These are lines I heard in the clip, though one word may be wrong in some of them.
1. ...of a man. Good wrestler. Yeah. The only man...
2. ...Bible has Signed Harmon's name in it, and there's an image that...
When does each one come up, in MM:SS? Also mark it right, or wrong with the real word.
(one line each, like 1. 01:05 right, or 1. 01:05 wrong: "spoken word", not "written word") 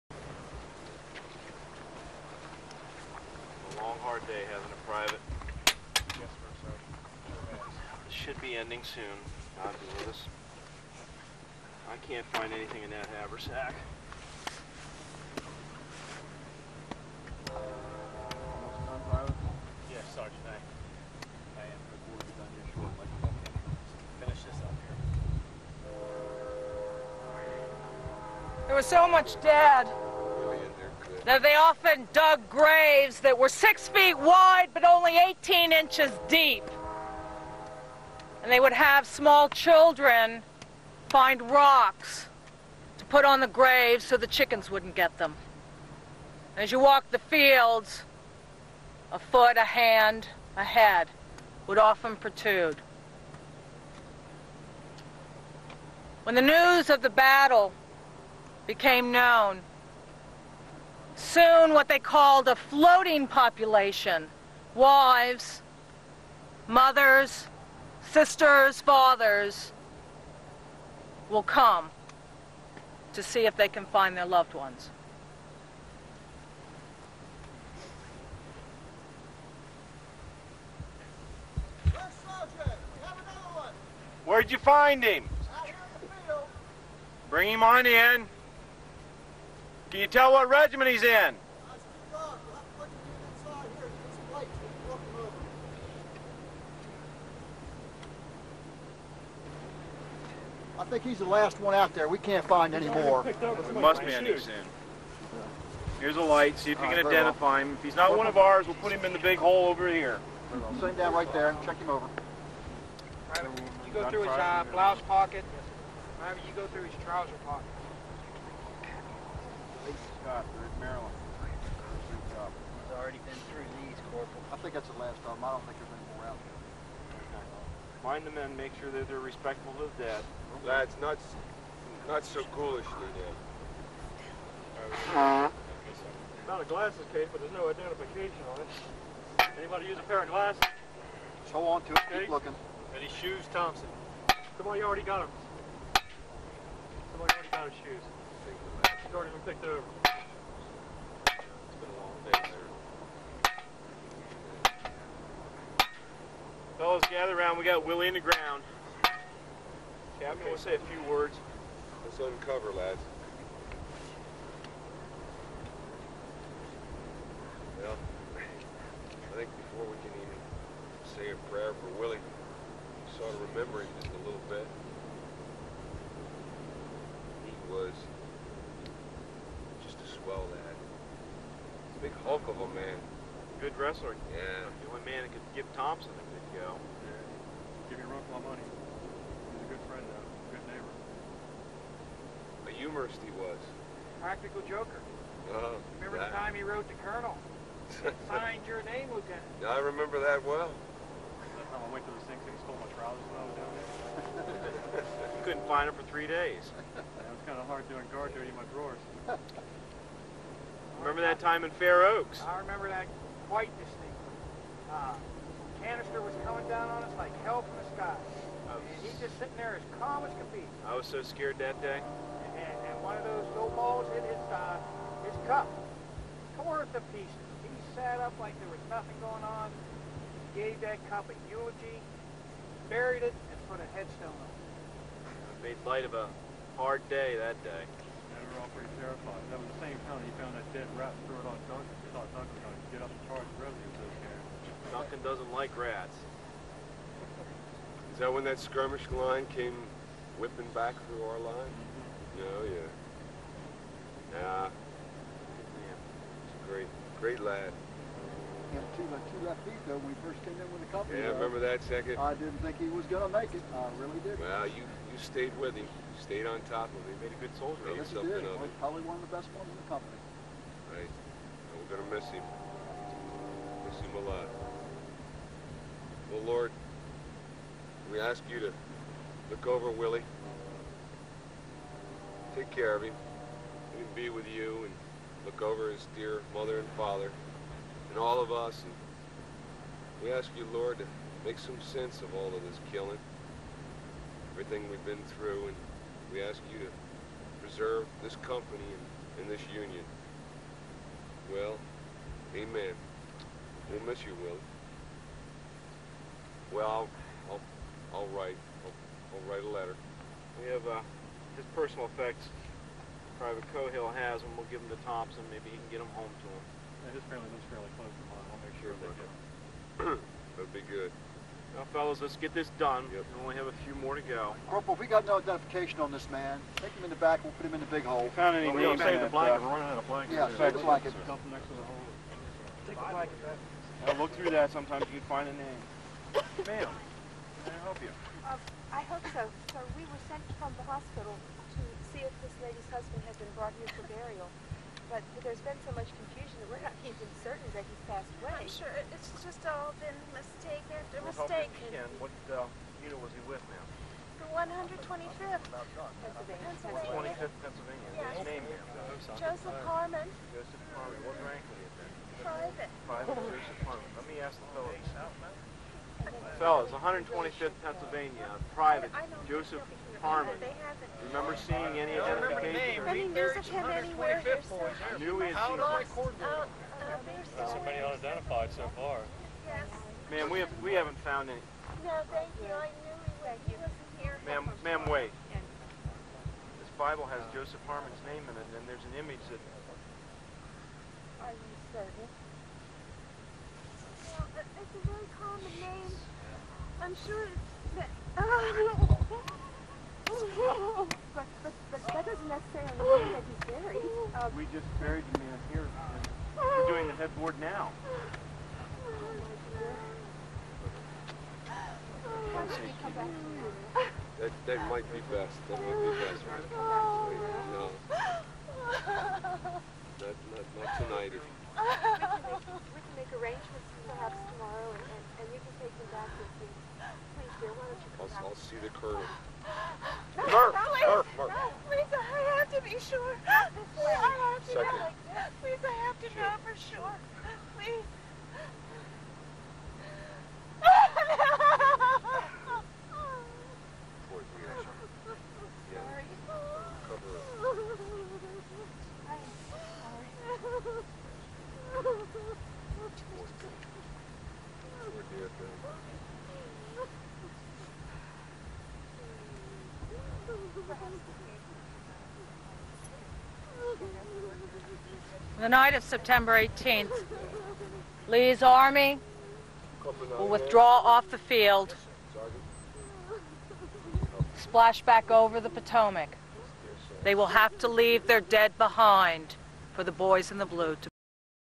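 1. 03:02 right
2. 06:26 wrong: "Joseph", not "Signed".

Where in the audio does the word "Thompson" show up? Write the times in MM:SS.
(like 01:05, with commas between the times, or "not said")
02:23, 03:05, 05:15.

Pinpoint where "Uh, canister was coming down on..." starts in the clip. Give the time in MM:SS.
03:34.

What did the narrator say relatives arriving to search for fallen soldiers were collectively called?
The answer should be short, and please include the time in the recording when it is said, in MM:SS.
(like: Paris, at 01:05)
floating population, at 01:02.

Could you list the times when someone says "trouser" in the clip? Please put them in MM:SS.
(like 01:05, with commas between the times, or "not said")
01:57, 03:22.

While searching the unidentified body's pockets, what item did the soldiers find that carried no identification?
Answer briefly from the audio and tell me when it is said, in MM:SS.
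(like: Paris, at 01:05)
A glasses case, at 02:16.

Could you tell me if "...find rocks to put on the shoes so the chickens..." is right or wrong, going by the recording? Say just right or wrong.
wrong.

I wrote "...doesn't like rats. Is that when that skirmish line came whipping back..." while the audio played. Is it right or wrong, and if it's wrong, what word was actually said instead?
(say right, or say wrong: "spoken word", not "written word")
right.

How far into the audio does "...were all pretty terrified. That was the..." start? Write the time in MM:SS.
03:58.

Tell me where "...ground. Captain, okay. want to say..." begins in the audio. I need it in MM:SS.
02:38.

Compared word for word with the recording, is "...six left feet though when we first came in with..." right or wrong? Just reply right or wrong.
wrong.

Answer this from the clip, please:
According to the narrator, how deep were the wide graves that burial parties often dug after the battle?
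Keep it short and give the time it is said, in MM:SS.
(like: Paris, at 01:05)
18 inches, at 00:35.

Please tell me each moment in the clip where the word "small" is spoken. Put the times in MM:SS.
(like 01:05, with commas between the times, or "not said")
00:39.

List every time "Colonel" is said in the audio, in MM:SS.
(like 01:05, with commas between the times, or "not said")
03:17.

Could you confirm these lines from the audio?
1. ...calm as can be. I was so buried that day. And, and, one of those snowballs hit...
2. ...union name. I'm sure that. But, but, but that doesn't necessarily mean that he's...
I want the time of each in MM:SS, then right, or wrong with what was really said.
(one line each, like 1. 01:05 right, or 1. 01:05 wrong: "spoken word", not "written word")
1. 03:39 wrong: "scared", not "buried"
2. 06:35 wrong: "common", not "union".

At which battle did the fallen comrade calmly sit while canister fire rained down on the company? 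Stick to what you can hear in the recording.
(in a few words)
Fair Oaks.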